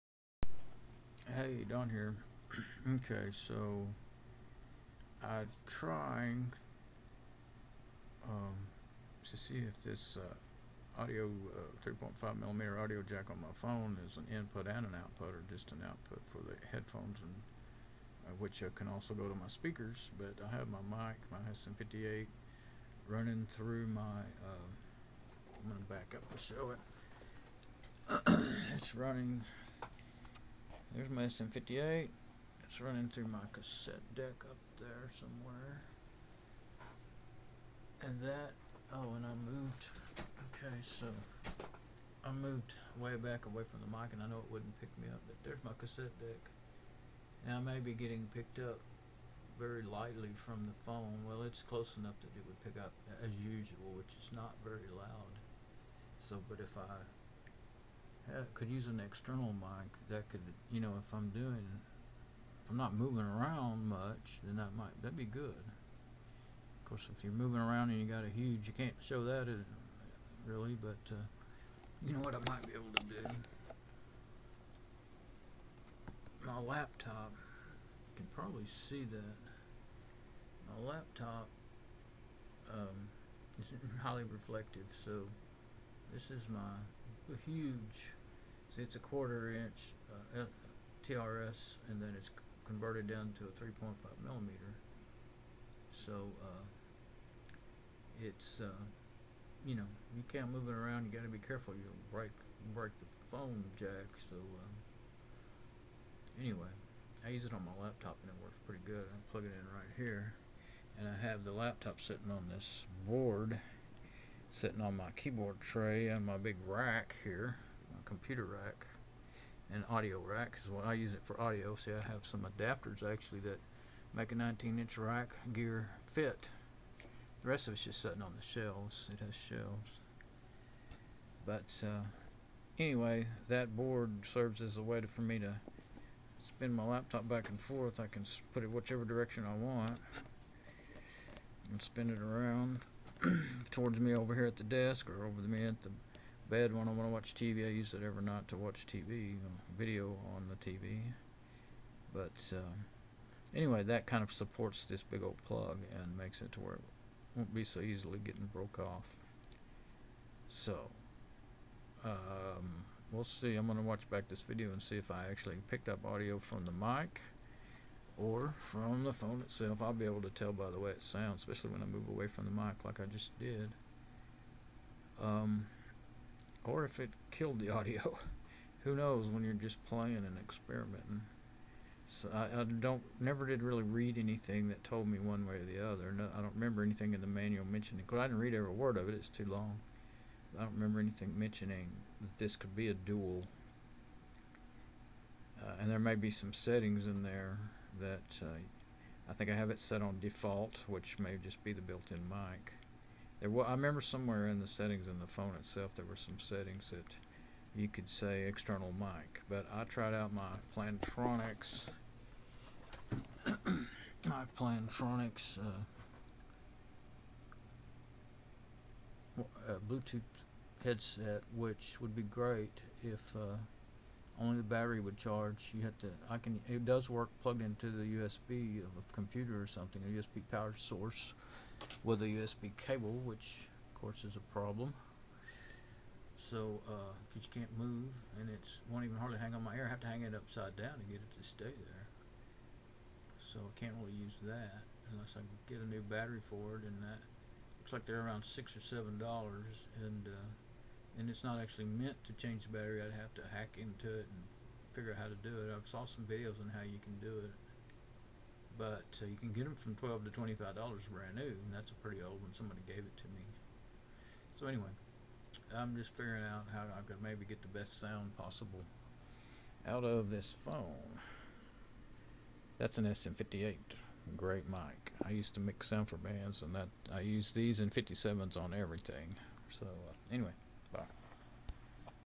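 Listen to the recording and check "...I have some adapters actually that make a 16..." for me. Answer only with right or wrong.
wrong.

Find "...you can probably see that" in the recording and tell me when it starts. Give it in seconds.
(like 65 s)
77 s.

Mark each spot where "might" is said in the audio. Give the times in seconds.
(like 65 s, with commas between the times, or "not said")
64 s, 72 s.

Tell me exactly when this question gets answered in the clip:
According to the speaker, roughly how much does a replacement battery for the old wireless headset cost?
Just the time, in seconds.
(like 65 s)
248 s.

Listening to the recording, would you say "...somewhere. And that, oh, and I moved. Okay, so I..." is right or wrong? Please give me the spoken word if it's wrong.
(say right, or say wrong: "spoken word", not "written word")
right.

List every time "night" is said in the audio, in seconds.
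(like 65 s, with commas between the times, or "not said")
148 s.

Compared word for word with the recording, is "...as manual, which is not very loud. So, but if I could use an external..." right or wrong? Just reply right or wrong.
wrong.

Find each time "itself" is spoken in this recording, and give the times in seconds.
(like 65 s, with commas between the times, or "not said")
169 s, 205 s.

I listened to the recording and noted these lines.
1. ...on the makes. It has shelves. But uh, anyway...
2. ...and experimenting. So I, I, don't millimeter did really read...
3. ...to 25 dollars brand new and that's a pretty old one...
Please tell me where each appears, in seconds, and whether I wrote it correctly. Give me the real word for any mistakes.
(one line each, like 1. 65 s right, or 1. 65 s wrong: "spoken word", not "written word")
1. 128 s wrong: "shelves", not "makes"
2. 180 s wrong: "never", not "millimeter"
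3. 260 s right.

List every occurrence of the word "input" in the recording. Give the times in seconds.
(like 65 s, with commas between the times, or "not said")
14 s.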